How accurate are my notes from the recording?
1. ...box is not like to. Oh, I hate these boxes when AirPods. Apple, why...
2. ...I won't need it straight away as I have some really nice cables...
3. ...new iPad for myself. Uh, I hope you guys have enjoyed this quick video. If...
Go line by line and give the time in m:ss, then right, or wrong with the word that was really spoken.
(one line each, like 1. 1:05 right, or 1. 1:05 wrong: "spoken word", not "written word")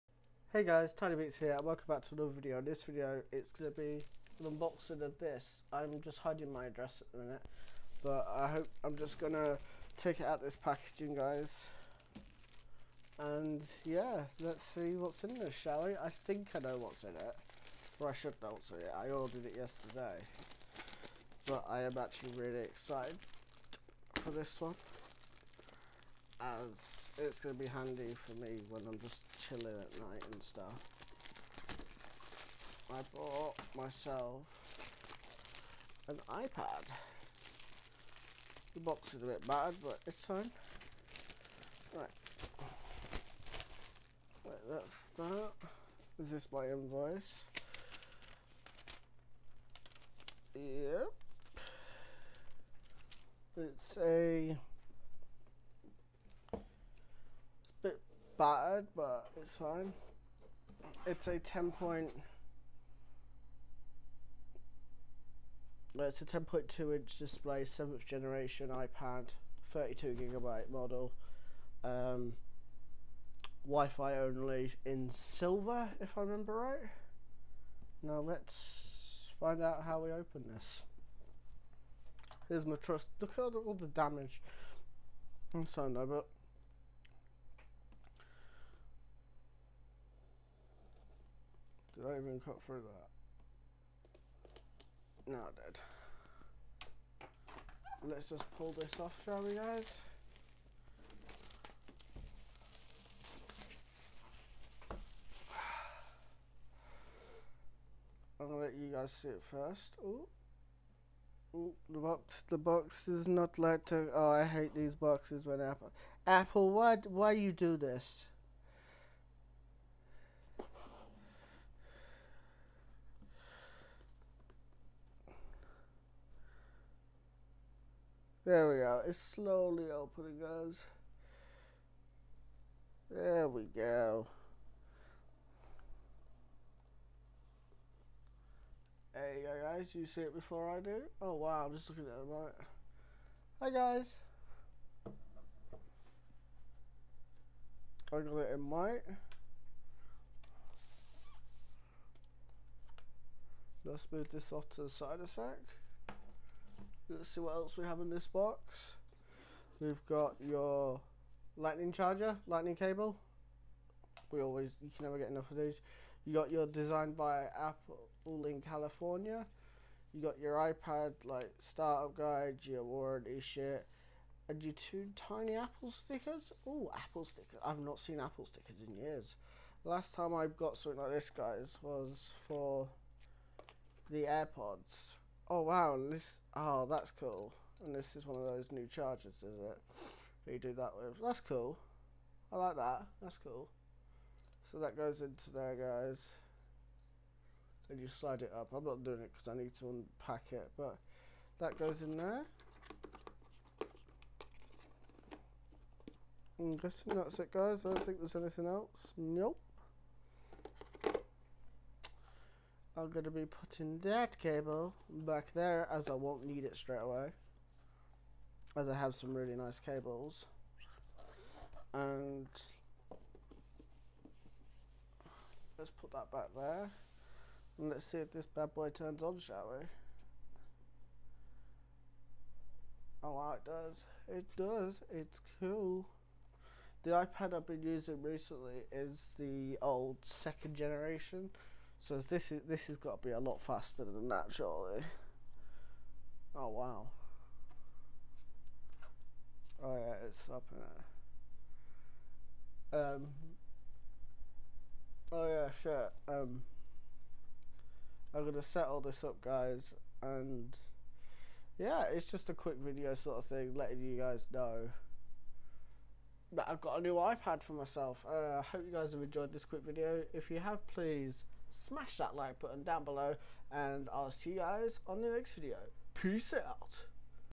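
1. 1:52 wrong: "Apple", not "AirPods"
2. 3:36 right
3. 4:27 right.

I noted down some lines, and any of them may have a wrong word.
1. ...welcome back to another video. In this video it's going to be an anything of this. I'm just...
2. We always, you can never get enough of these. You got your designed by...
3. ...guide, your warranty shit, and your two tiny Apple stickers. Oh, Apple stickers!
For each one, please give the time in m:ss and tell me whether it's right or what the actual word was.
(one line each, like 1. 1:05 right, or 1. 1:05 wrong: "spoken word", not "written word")
1. 0:01 wrong: "unboxing", not "anything"
2. 2:44 right
3. 2:52 right.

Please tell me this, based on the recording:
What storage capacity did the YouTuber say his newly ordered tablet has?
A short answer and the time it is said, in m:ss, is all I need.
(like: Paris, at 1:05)
32 gigabytes, at 1:09.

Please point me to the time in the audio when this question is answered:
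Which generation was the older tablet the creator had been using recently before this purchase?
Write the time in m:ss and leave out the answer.
4:00.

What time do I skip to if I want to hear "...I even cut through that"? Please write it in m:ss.
1:32.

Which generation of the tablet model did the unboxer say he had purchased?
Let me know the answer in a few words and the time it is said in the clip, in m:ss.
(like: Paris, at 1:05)
7th generation, at 1:07.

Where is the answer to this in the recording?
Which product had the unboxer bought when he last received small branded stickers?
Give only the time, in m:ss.
3:04.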